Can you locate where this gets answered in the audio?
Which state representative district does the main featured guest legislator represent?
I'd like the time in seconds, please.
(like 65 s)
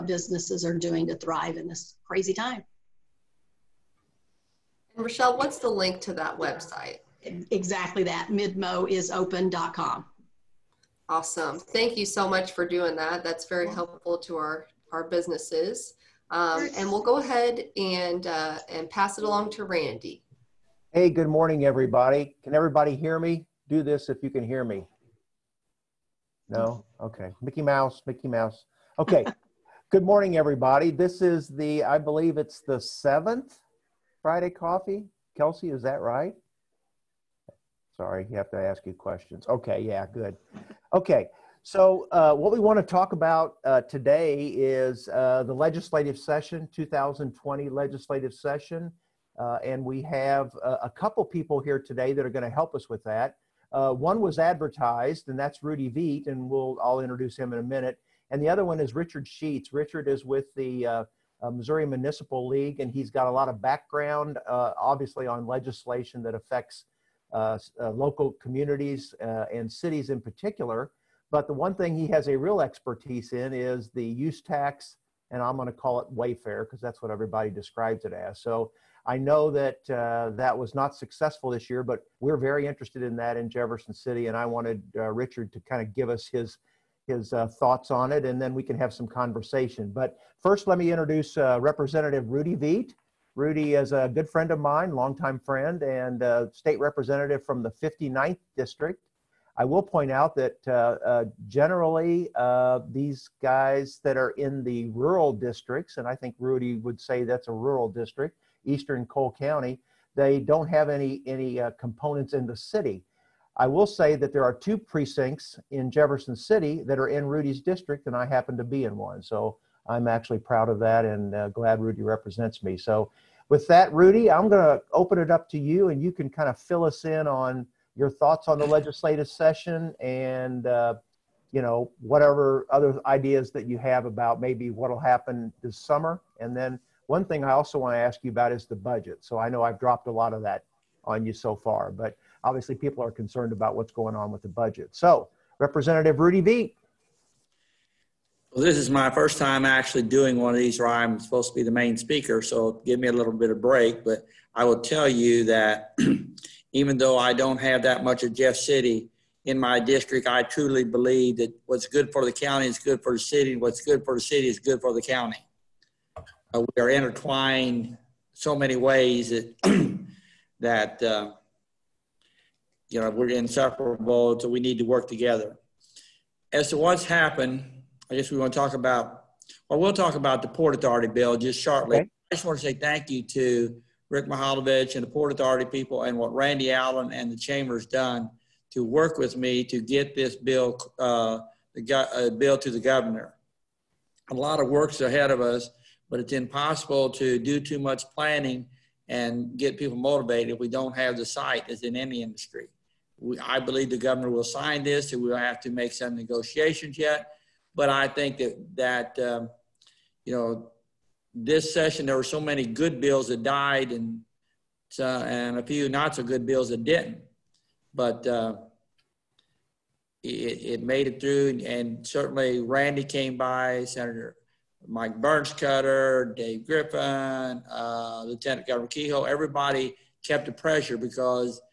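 97 s.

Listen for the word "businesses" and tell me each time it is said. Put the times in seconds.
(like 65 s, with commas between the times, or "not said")
0 s, 15 s.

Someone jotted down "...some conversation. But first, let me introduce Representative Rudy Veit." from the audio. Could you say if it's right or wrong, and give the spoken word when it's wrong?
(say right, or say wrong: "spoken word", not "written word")
right.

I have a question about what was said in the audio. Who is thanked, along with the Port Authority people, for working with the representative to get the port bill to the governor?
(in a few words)
Rick Mihalovich.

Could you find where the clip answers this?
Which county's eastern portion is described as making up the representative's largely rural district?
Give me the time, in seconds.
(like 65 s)
109 s.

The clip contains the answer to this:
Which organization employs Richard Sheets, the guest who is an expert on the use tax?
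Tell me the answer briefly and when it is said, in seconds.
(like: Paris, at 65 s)
Missouri Municipal League, at 61 s.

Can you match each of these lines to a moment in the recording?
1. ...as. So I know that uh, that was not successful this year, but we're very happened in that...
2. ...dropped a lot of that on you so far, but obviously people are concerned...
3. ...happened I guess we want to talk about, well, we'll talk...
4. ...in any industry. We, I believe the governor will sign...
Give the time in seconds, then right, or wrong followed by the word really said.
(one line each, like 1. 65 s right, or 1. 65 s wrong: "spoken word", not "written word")
1. 78 s wrong: "interested", not "happened"
2. 139 s right
3. 177 s right
4. 201 s right.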